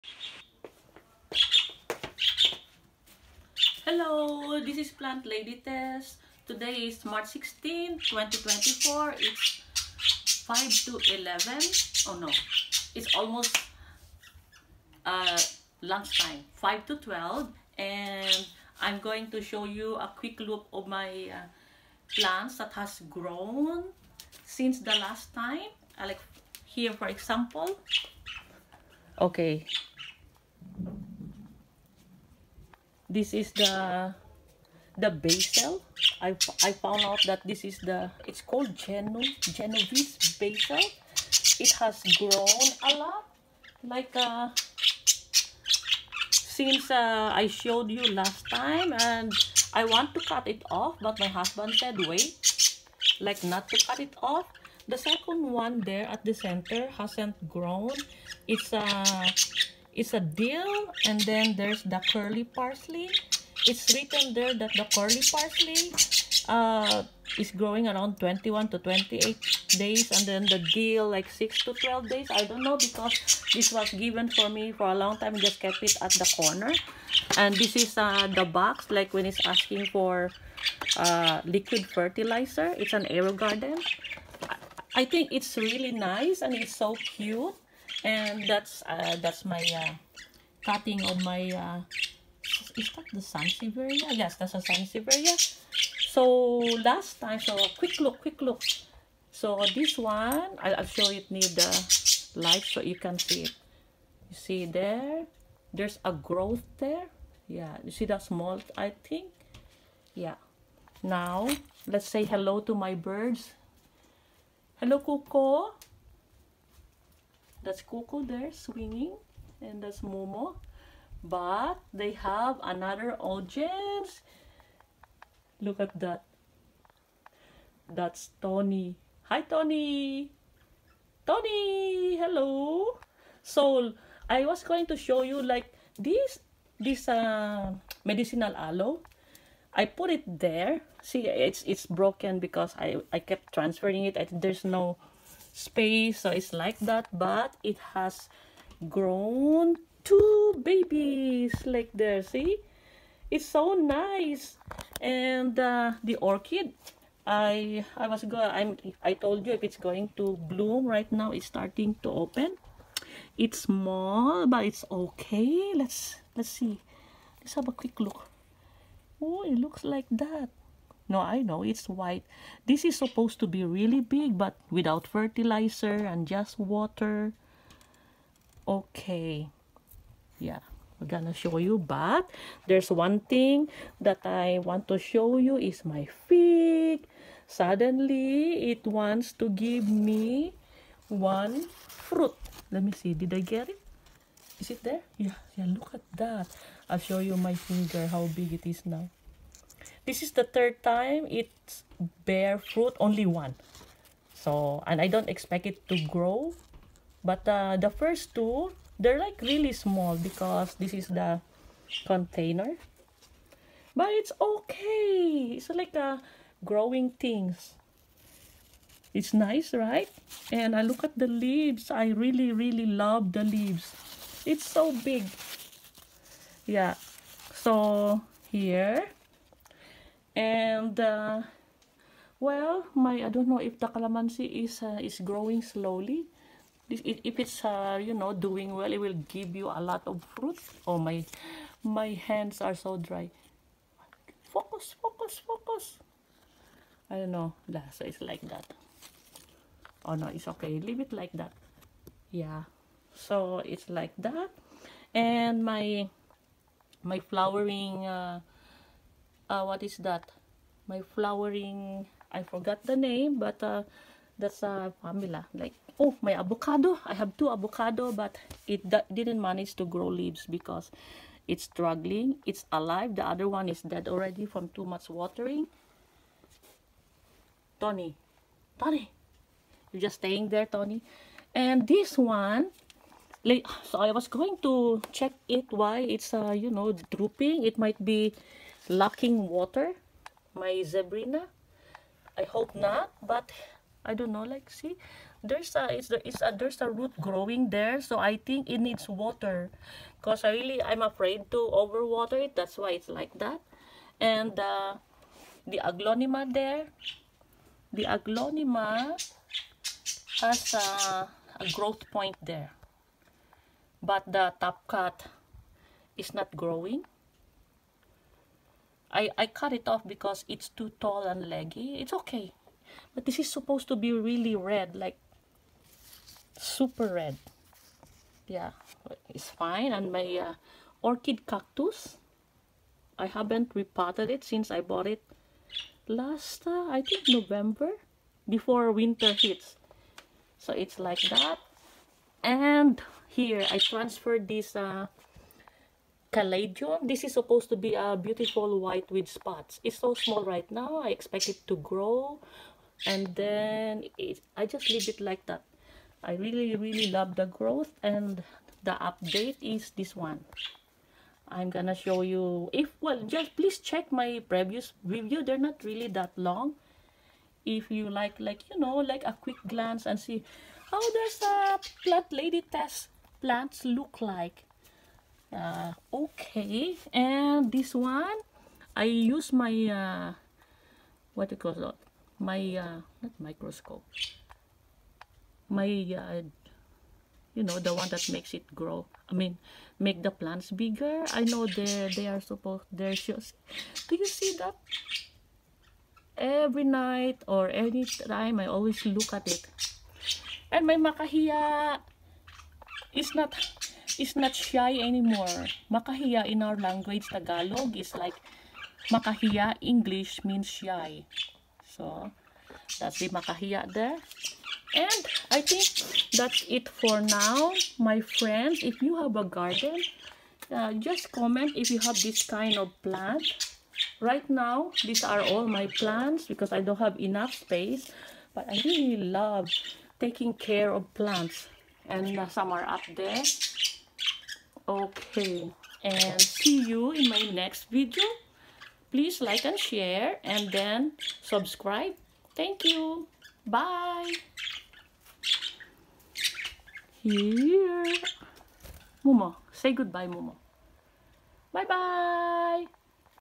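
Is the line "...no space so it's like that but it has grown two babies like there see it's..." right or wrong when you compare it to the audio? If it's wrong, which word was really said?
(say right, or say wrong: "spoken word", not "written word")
right.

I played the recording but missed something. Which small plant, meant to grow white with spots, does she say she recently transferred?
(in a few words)
caladium.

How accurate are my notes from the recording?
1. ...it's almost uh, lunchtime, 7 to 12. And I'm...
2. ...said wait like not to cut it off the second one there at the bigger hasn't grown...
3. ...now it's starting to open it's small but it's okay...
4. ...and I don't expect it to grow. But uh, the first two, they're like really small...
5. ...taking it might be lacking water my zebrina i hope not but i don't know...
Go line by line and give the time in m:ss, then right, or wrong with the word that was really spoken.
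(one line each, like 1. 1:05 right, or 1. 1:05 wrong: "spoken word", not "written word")
1. 0:12 wrong: "5", not "7"
2. 0:51 wrong: "center", not "bigger"
3. 2:41 right
4. 3:24 right
5. 4:47 wrong: "drooping", not "taking".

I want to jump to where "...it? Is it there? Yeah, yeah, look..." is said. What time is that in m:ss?
3:13.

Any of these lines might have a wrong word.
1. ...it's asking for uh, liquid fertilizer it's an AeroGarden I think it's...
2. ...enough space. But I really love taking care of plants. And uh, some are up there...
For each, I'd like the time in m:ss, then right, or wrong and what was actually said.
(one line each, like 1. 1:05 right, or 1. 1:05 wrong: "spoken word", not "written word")
1. 1:19 right
2. 7:07 right.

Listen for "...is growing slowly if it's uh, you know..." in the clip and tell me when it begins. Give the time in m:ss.
3:55.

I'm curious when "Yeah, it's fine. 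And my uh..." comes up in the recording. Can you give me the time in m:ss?
5:28.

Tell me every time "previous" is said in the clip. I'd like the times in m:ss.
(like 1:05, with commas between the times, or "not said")
6:04.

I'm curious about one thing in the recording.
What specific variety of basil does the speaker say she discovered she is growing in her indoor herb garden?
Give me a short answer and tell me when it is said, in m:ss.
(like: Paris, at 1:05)
Genovese, at 0:39.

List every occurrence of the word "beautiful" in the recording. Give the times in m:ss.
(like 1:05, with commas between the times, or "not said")
5:48.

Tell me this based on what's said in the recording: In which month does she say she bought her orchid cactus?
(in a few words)
November.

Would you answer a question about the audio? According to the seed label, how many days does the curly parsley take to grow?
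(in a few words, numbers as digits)
21 to 28 days.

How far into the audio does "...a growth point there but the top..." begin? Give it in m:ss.
5:11.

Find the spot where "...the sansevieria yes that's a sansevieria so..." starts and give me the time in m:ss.
1:33.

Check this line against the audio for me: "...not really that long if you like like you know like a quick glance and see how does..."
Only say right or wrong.
right.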